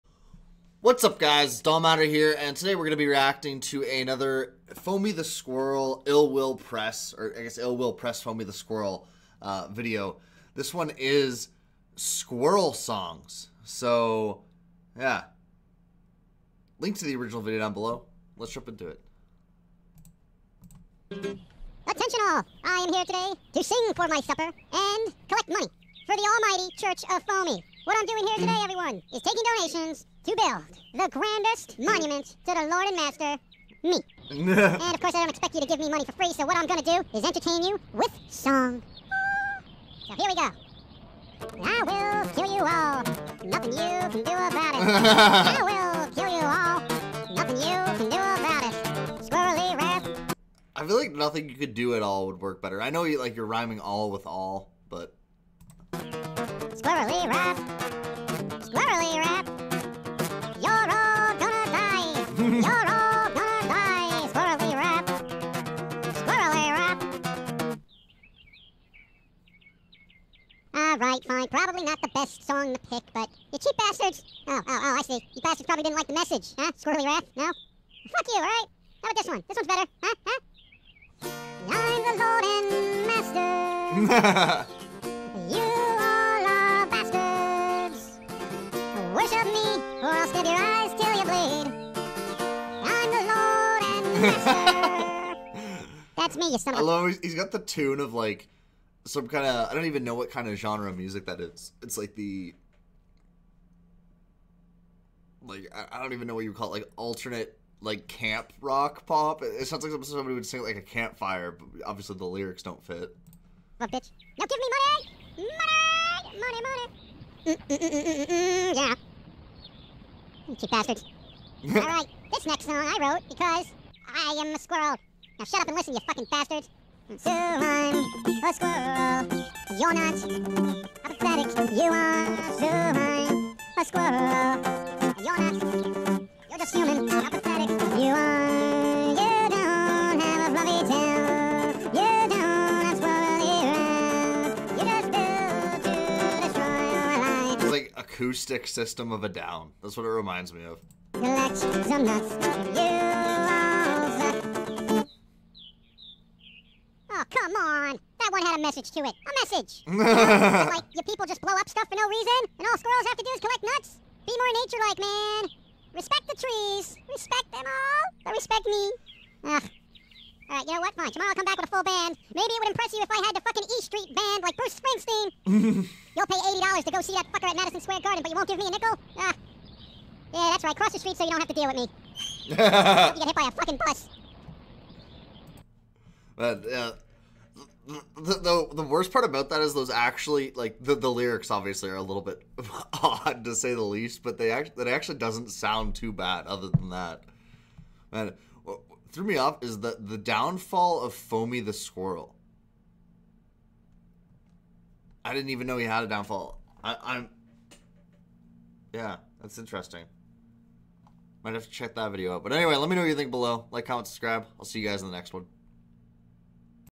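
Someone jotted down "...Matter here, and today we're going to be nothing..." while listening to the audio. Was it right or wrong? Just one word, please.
wrong.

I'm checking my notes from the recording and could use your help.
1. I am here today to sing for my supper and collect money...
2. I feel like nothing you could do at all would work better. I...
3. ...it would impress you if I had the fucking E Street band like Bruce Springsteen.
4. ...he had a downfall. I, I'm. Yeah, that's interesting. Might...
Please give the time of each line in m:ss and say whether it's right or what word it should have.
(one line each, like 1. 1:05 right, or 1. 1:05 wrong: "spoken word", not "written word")
1. 0:22 right
2. 0:50 right
3. 2:52 right
4. 3:25 right.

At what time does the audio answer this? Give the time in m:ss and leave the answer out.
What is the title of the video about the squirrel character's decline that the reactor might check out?
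3:19.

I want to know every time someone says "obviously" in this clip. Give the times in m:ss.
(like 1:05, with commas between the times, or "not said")
1:51, 3:11.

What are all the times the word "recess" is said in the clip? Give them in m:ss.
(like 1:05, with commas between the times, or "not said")
not said.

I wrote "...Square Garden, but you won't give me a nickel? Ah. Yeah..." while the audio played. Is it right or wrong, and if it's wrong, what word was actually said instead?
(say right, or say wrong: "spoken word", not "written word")
right.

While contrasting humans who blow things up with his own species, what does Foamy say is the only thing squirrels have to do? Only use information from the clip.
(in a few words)
collect nuts.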